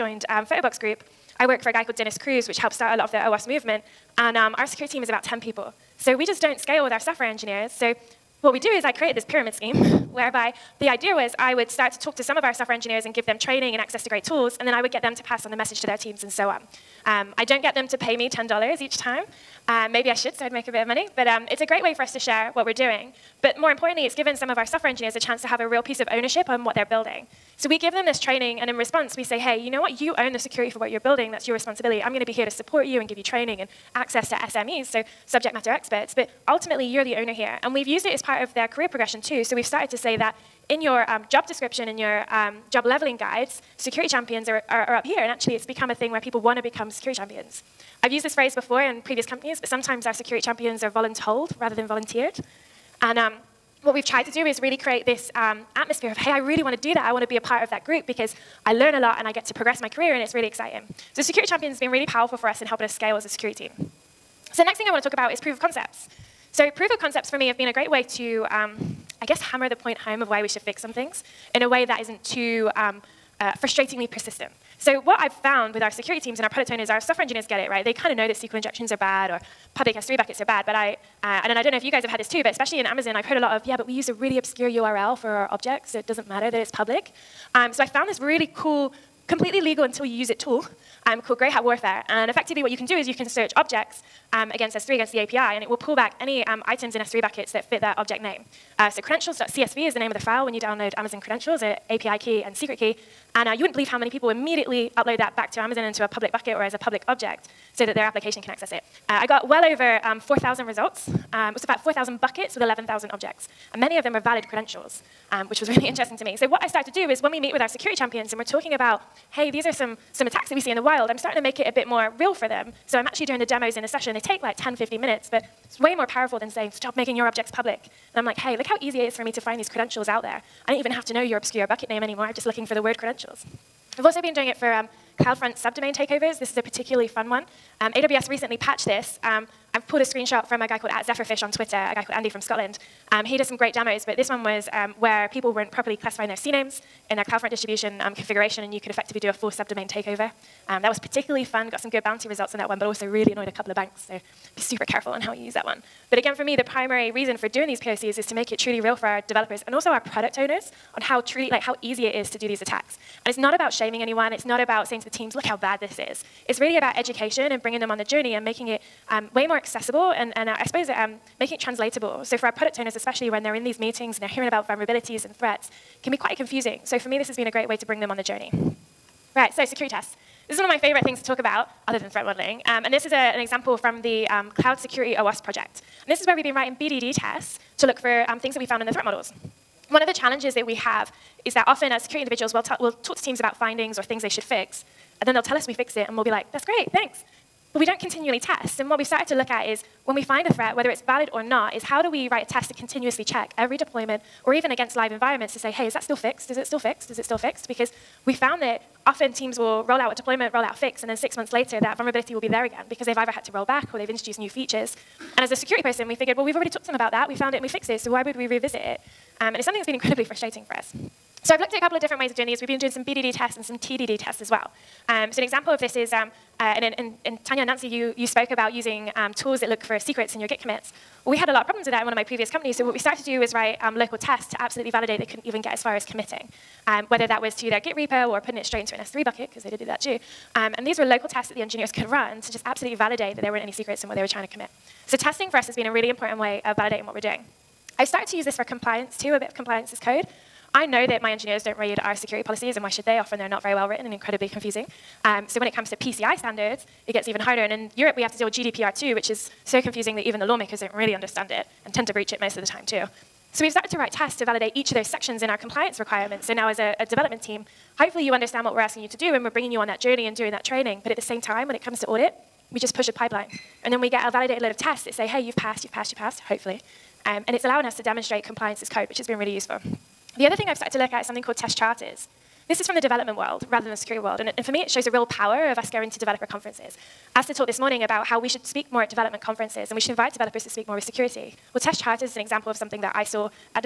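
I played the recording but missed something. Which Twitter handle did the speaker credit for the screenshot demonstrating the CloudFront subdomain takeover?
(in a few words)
ZephrFish.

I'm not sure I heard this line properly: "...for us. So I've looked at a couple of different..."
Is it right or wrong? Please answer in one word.
right.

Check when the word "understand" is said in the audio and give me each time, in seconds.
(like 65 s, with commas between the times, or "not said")
261 s, 268 s.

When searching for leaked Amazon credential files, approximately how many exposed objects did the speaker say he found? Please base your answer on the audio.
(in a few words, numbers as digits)
11,000.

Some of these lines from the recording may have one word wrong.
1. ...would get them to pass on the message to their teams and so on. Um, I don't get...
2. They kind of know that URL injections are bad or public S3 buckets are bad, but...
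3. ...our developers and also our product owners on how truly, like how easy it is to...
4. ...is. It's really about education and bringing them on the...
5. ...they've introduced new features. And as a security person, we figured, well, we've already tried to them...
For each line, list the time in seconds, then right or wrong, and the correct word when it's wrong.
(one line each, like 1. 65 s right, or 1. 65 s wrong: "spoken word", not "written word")
1. 14 s right
2. 77 s wrong: "SQL", not "URL"
3. 159 s right
4. 165 s right
5. 213 s wrong: "talked", not "tried".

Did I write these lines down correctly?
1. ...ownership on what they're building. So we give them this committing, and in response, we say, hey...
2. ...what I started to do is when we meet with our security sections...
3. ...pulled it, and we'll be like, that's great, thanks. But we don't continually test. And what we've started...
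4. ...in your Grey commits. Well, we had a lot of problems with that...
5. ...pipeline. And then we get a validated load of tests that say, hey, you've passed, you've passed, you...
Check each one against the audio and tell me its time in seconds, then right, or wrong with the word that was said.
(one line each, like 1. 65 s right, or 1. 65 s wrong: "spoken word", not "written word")
1. 26 s wrong: "training", not "committing"
2. 116 s wrong: "champions", not "sections"
3. 195 s wrong: "fixed", not "pulled"
4. 230 s wrong: "Git", not "Grey"
5. 273 s right.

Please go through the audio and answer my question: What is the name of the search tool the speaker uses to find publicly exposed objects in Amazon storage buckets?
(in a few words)
Grey Hat Warfare.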